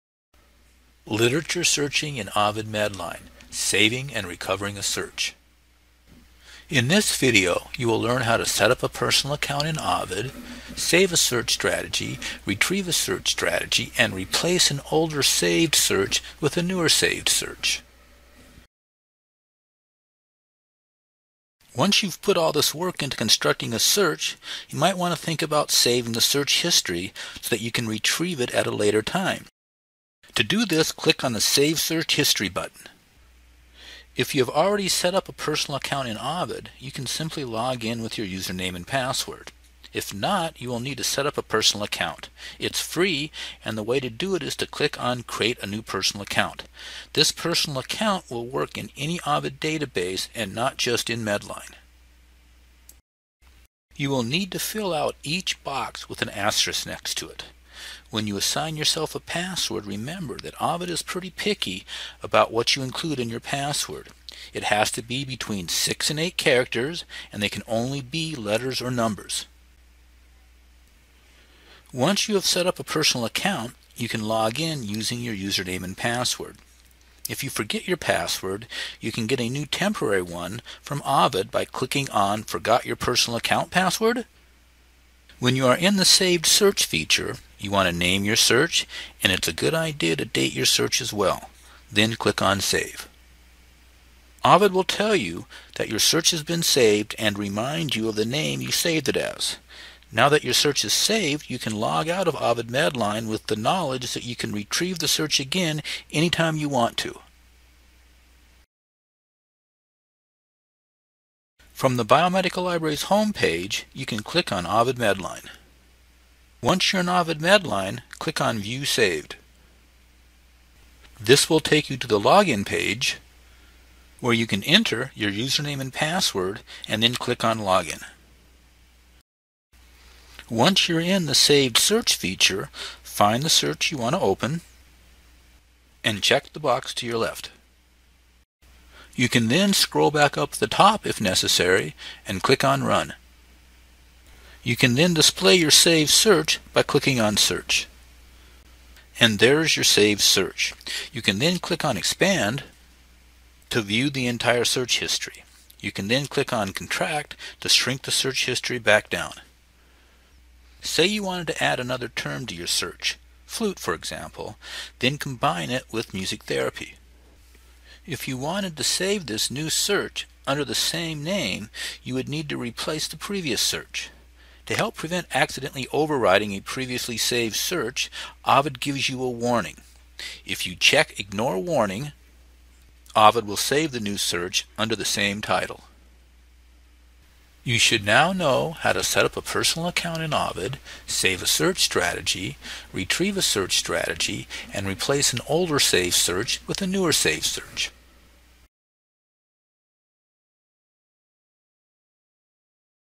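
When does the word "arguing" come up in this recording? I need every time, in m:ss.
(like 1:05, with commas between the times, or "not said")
not said.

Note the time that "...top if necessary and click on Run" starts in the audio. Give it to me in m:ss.
2:20.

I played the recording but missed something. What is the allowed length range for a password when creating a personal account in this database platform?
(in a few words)
6 and 8 characters.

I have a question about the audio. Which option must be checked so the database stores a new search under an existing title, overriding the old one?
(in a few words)
Ignore Warning.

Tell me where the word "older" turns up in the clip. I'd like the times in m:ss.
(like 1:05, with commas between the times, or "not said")
0:14, 3:15.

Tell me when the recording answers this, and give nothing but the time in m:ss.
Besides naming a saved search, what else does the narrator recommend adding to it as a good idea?
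1:30.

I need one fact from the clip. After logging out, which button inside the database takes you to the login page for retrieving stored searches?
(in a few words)
View Saved.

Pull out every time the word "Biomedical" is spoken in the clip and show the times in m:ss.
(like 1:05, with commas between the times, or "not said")
1:52.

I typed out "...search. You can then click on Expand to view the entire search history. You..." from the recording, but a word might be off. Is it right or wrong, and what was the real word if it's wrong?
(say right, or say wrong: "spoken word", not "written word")
right.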